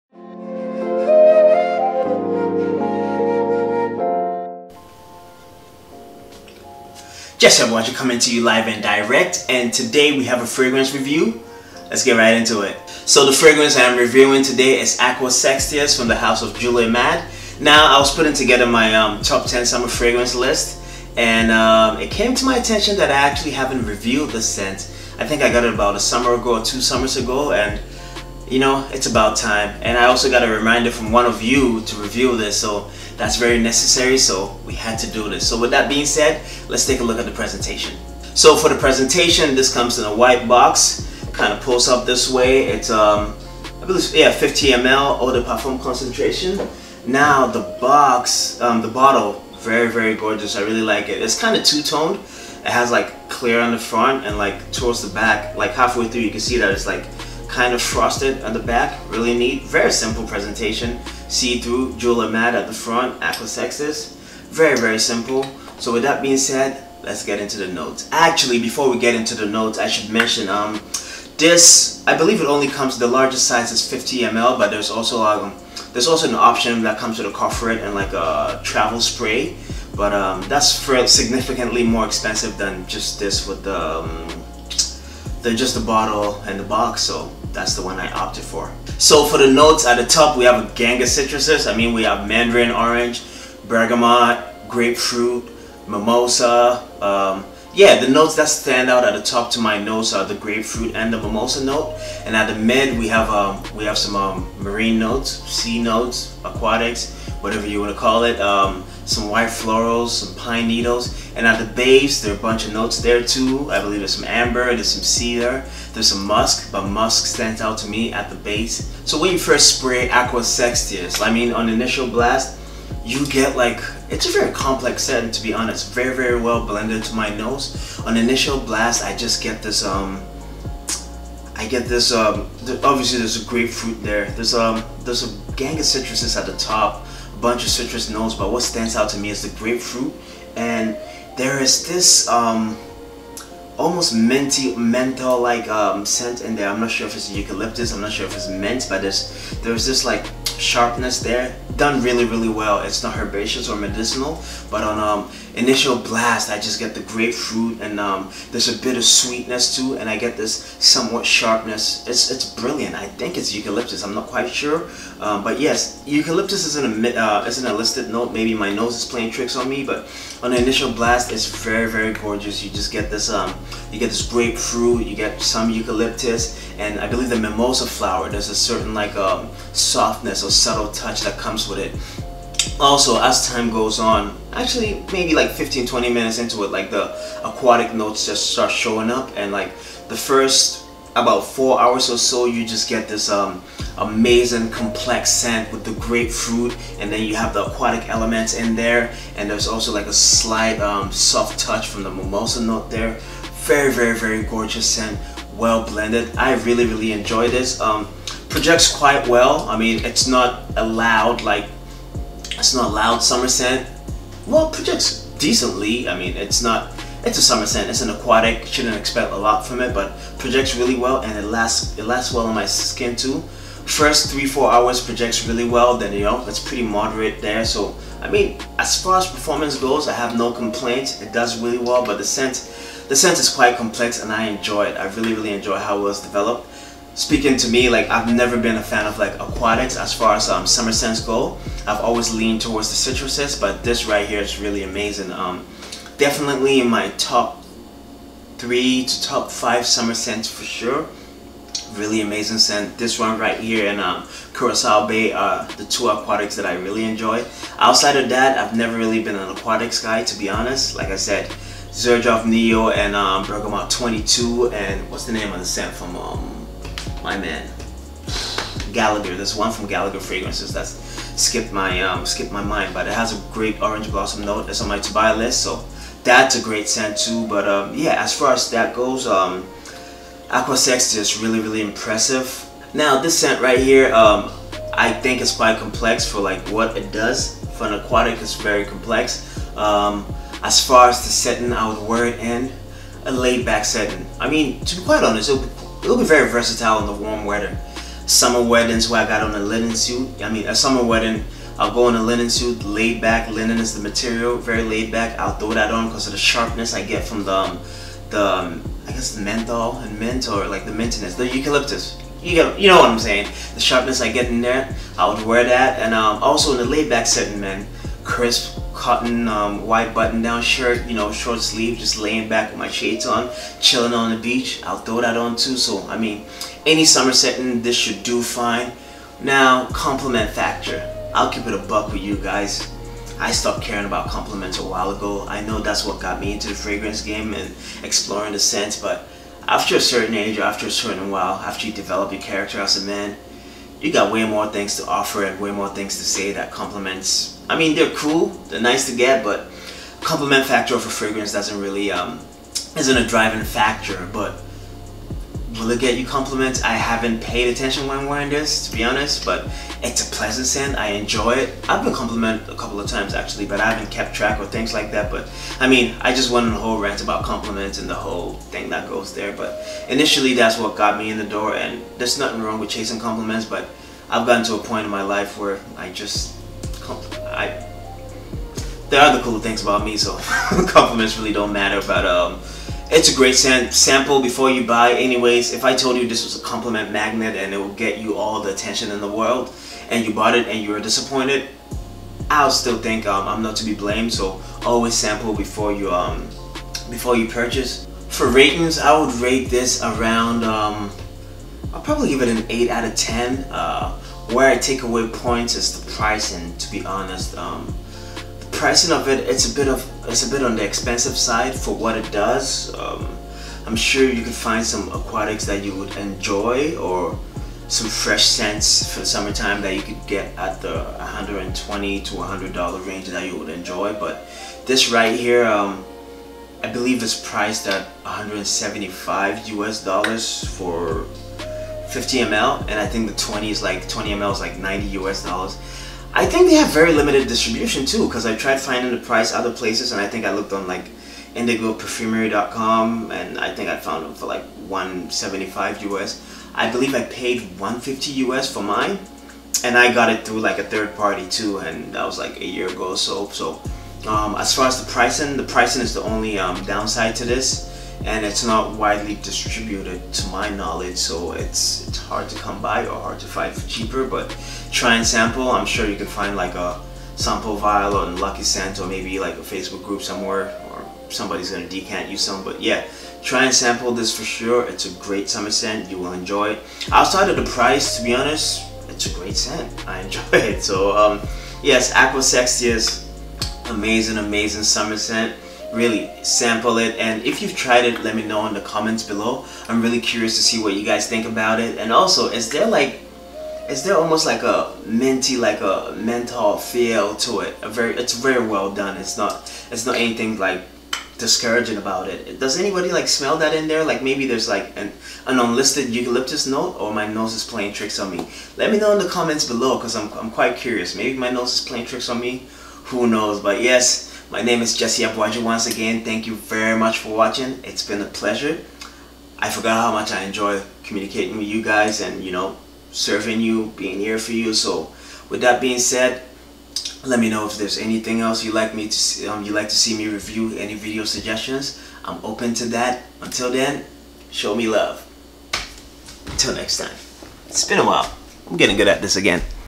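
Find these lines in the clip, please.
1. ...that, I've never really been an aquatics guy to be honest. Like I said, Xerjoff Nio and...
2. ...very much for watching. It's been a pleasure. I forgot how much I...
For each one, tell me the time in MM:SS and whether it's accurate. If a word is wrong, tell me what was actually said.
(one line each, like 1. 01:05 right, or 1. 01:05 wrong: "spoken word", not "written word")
1. 04:18 right
2. 08:36 right.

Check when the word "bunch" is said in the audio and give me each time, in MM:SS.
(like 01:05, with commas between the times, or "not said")
01:52, 02:17.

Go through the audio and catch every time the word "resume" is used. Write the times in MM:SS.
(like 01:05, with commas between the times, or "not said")
not said.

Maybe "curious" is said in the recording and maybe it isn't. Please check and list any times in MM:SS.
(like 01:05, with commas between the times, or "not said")
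08:10, 08:30.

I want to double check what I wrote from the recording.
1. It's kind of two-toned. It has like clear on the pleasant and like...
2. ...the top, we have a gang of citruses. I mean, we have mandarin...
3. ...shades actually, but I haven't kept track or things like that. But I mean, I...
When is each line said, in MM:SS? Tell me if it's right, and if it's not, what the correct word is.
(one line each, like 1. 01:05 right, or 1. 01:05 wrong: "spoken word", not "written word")
1. 00:51 wrong: "front", not "pleasant"
2. 01:29 right
3. 06:03 wrong: "times", not "shades".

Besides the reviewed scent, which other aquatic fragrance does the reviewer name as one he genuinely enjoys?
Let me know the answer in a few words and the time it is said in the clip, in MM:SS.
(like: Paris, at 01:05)
Curacao Bay, at 04:14.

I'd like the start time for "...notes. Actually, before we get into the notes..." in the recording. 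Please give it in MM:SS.
01:07.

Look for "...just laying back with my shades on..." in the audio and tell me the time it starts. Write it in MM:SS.
05:21.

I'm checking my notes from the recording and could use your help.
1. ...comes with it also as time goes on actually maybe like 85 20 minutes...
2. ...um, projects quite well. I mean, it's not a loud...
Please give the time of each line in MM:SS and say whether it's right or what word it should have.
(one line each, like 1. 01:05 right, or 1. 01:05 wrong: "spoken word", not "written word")
1. 03:01 wrong: "15", not "85"
2. 03:27 right.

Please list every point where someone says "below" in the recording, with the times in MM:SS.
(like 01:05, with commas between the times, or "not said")
08:09, 08:29.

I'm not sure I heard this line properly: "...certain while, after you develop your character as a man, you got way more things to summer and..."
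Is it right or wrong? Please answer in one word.
wrong.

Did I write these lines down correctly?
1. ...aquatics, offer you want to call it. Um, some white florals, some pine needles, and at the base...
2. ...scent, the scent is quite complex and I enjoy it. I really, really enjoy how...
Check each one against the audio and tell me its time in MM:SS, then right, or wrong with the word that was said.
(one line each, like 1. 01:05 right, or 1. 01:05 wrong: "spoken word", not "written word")
1. 01:46 wrong: "whatever", not "offer"
2. 03:52 right.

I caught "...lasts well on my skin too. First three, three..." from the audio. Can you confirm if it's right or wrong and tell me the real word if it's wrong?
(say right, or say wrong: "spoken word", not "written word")
wrong: "four", not "three".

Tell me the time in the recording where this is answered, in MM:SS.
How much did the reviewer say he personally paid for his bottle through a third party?
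07:27.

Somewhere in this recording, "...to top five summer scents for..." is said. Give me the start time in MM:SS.
04:09.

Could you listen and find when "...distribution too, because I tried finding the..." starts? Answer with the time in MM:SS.
07:17.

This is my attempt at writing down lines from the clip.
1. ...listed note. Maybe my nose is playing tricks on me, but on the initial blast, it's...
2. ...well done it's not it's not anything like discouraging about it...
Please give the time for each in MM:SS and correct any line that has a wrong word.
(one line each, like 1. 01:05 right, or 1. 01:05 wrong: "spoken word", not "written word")
1. 02:47 right
2. 08:18 right.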